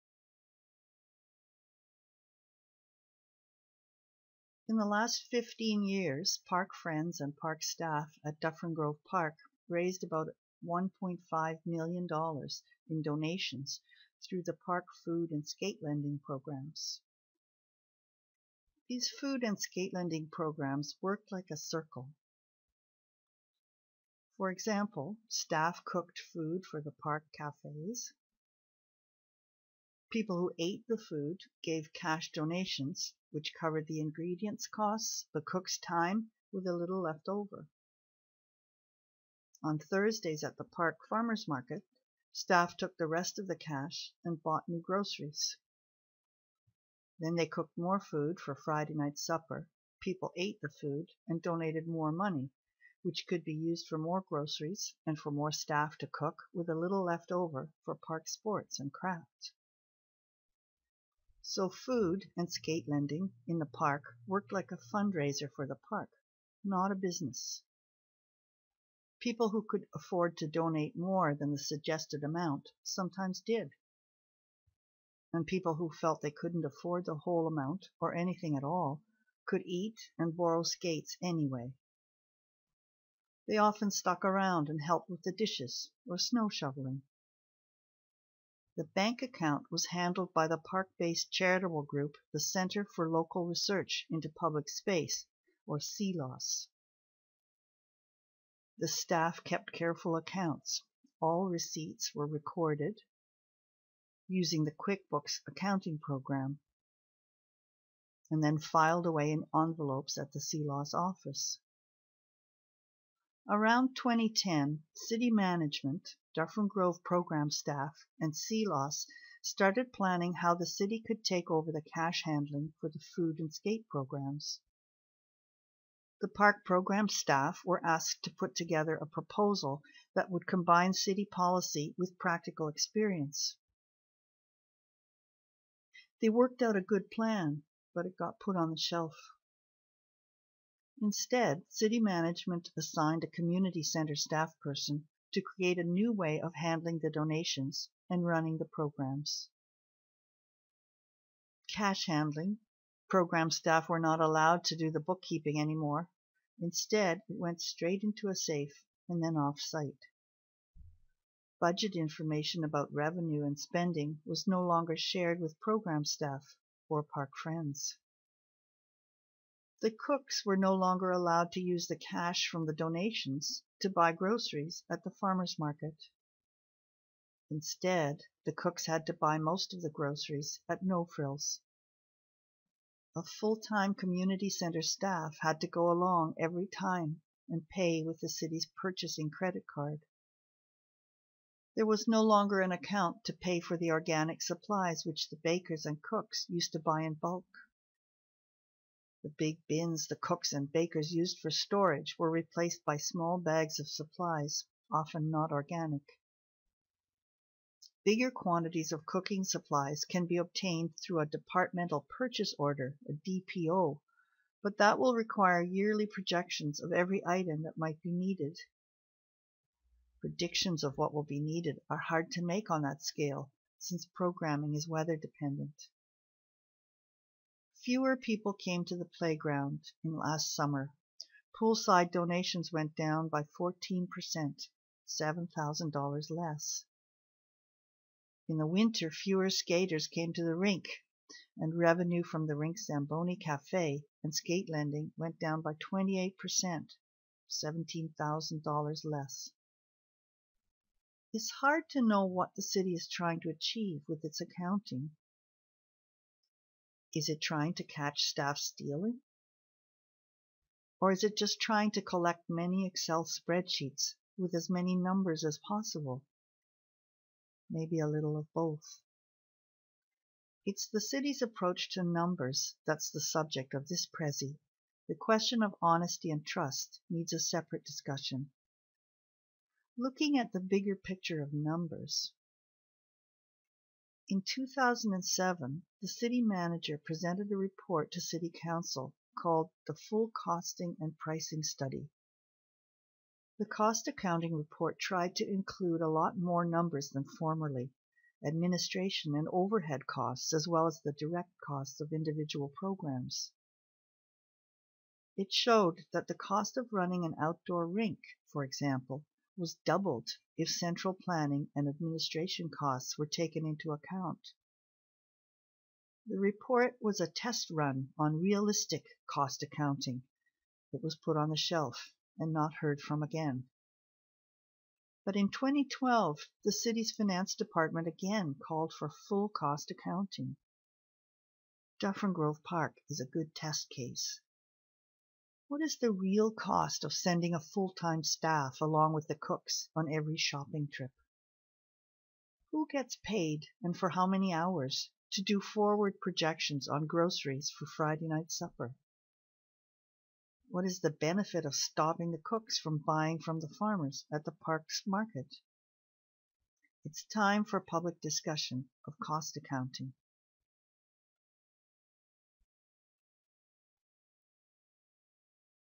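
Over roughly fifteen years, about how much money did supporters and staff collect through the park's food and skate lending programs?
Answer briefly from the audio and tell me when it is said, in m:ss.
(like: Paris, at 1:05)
$1.5 million, at 0:10.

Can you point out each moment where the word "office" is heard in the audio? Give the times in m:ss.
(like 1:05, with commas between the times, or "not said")
1:50.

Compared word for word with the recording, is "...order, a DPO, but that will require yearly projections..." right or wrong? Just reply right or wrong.
right.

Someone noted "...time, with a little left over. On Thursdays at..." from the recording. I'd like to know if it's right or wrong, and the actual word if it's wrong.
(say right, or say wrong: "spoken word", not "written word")
right.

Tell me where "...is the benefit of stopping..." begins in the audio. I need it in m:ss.
5:50.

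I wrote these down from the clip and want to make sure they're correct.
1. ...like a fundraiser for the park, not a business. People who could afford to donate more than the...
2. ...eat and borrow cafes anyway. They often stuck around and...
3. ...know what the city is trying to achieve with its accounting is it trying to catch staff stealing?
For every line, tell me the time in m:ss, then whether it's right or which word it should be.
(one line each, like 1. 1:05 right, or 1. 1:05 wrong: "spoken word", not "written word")
1. 1:04 right
2. 1:19 wrong: "skates", not "cafes"
3. 4:12 right.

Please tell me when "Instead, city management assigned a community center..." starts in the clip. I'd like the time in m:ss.
2:21.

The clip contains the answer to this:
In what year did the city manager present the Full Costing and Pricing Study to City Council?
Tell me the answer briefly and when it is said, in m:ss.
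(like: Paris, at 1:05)
2007, at 4:44.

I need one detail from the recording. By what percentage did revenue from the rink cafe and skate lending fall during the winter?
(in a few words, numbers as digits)
28%.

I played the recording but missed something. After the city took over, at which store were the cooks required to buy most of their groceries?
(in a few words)
No Frills.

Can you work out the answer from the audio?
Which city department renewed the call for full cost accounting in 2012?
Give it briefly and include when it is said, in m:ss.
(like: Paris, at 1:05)
finance department, at 5:27.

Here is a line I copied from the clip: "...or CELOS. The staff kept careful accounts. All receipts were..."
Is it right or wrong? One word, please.
right.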